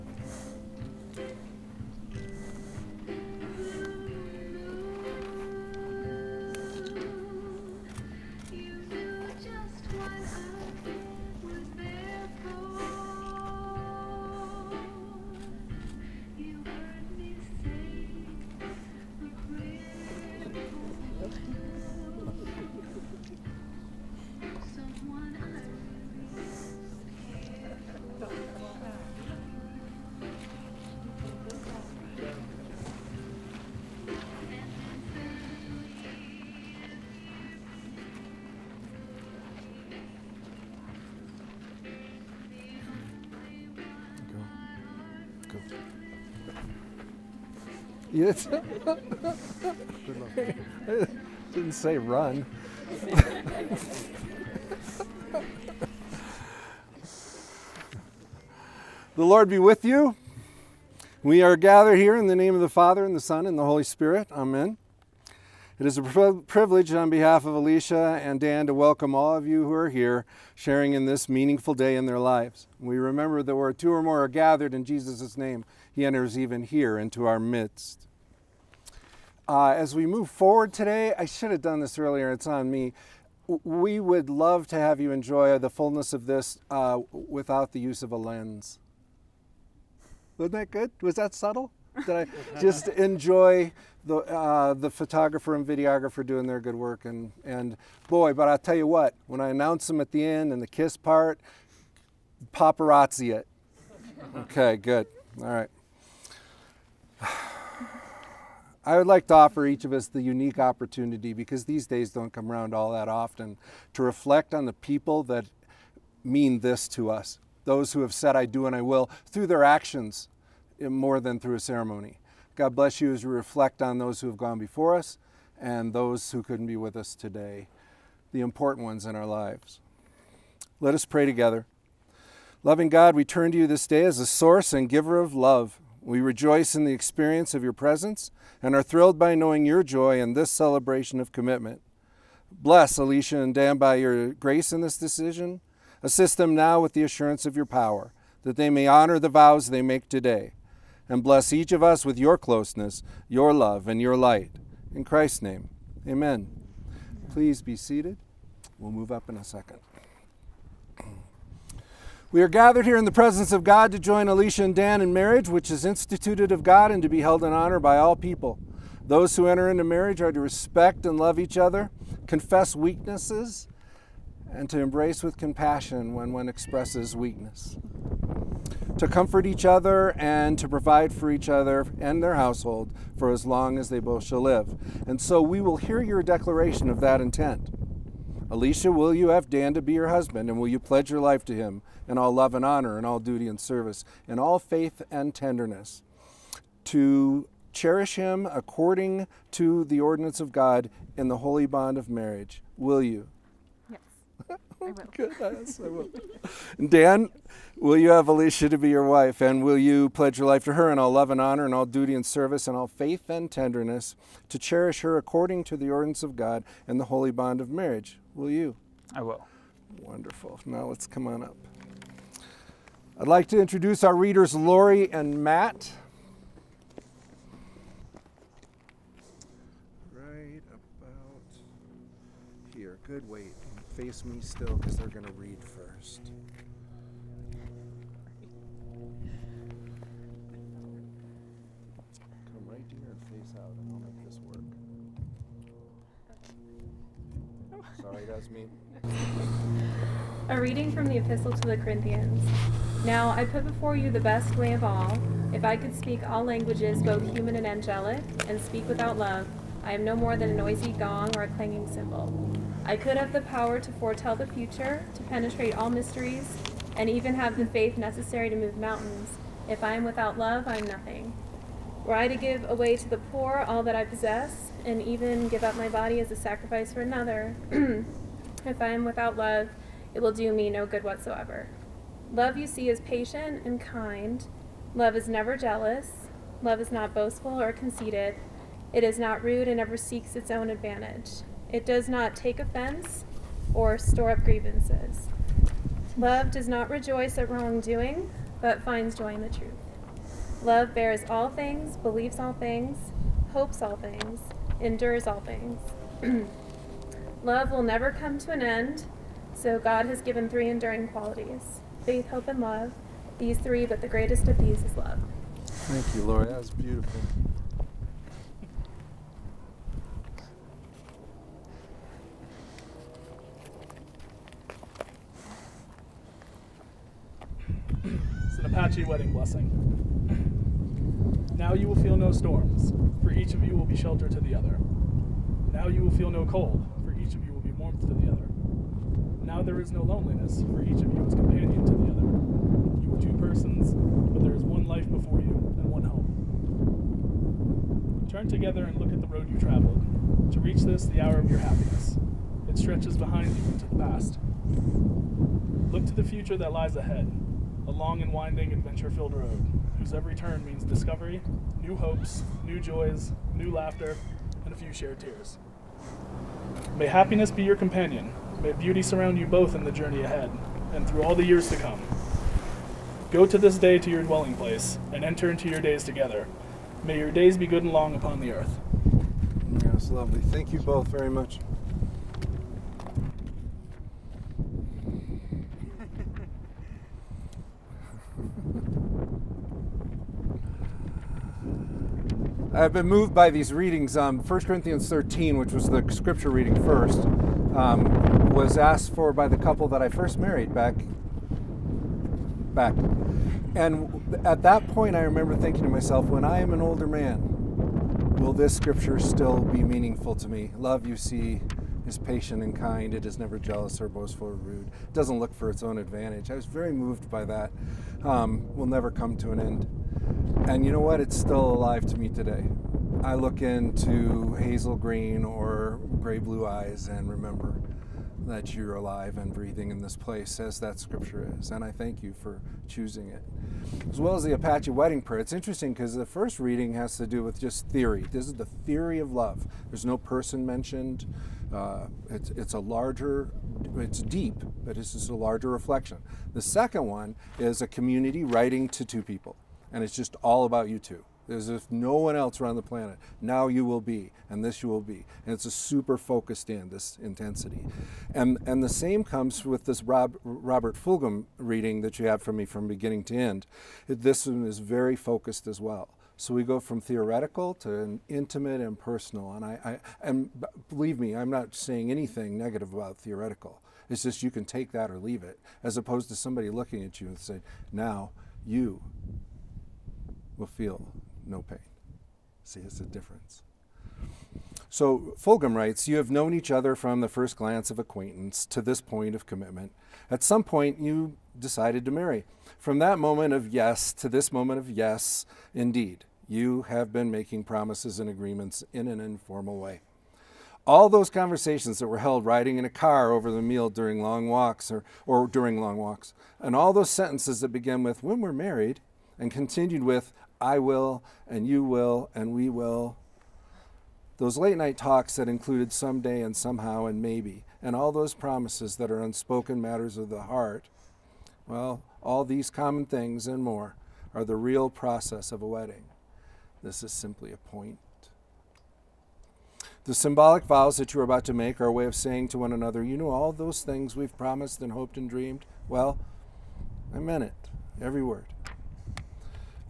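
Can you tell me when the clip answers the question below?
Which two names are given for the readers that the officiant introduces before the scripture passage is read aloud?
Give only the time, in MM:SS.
03:44.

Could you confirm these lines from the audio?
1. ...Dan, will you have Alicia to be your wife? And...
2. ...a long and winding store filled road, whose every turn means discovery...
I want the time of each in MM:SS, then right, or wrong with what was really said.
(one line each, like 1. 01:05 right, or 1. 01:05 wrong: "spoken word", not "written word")
1. 03:26 right
2. 05:57 wrong: "adventure", not "store".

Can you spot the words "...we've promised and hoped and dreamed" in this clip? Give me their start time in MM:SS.
08:54.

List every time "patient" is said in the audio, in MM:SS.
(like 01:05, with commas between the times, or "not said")
04:43, 06:52.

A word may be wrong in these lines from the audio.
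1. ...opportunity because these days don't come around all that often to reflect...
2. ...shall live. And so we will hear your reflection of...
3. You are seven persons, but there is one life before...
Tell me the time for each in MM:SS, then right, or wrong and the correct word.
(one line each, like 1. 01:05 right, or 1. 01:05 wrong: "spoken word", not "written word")
1. 01:50 right
2. 03:04 wrong: "declaration", not "reflection"
3. 05:43 wrong: "two", not "seven".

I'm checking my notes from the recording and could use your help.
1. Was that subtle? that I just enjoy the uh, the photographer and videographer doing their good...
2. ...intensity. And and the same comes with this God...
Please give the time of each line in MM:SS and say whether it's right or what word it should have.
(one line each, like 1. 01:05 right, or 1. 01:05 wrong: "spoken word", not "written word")
1. 01:31 right
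2. 07:37 wrong: "Rob", not "God".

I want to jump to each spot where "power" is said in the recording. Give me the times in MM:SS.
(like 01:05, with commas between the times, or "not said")
02:27, 04:23.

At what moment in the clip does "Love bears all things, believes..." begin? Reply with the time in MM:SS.
05:00.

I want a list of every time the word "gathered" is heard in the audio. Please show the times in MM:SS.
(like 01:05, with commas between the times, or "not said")
01:01, 01:14, 02:42.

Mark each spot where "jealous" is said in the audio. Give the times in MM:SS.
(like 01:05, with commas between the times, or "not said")
04:45, 06:53.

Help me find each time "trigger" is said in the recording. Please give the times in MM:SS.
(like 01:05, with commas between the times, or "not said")
not said.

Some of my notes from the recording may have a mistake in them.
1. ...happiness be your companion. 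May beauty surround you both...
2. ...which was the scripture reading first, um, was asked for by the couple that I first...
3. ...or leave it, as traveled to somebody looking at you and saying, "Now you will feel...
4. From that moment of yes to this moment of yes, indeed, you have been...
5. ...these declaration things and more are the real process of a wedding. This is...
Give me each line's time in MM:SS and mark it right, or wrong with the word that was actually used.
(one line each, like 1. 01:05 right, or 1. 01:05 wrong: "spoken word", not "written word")
1. 06:07 right
2. 06:35 right
3. 07:55 wrong: "opposed", not "traveled"
4. 08:12 right
5. 08:42 wrong: "common", not "declaration".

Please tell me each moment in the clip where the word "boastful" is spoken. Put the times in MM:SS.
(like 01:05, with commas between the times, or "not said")
04:47, 06:54.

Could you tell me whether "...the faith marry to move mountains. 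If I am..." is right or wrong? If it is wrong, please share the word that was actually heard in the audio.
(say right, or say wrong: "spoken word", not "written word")
wrong: "necessary", not "marry".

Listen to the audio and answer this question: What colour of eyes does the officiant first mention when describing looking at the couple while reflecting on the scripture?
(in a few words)
hazel green.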